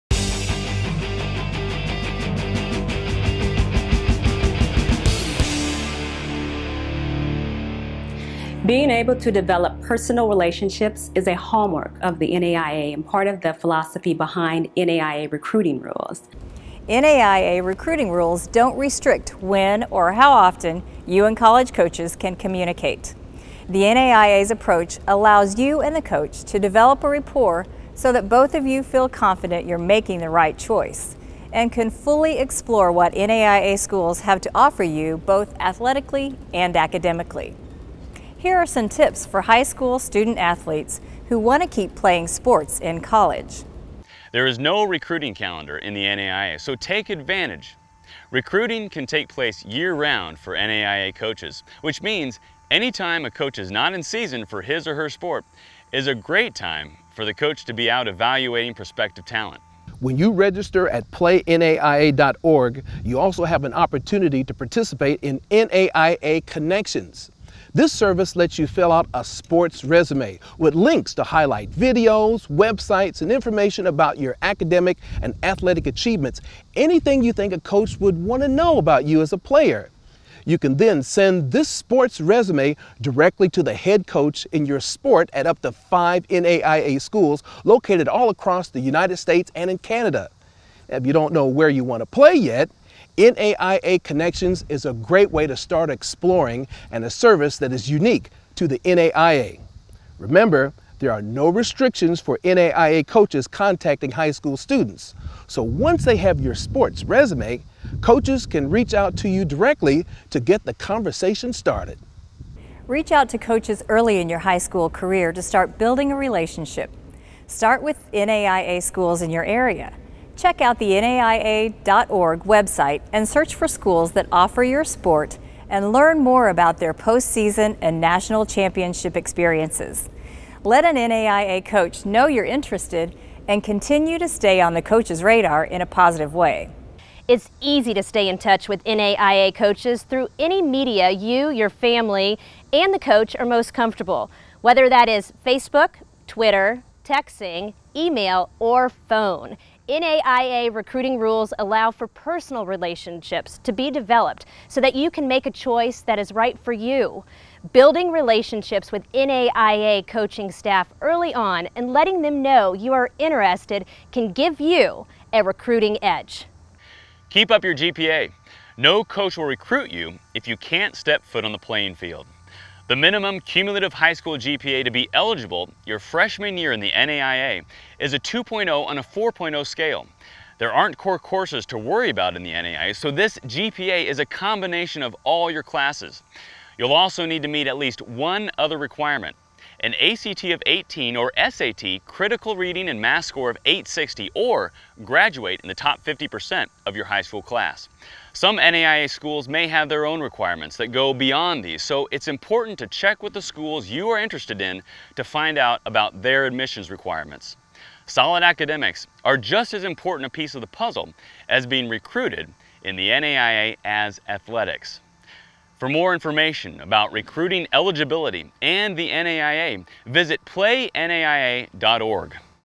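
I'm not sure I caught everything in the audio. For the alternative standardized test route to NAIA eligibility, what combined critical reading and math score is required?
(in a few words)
860.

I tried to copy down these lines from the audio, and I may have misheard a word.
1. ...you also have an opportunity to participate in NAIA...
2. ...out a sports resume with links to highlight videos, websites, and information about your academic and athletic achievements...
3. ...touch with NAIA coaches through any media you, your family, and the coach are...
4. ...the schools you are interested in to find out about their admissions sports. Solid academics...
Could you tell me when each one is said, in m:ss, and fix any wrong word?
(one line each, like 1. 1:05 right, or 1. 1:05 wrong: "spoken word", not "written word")
1. 1:03 right
2. 1:08 right
3. 2:18 right
4. 3:23 wrong: "requirements", not "sports".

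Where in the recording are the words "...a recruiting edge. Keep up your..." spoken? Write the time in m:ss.
2:45.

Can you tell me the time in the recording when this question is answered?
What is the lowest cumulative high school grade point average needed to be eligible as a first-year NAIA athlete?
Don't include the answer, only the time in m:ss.
2:58.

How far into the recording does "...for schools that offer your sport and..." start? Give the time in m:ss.
2:03.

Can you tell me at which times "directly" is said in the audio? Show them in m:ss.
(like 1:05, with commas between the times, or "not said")
1:22, 1:49.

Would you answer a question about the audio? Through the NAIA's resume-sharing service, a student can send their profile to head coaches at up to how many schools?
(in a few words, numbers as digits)
5.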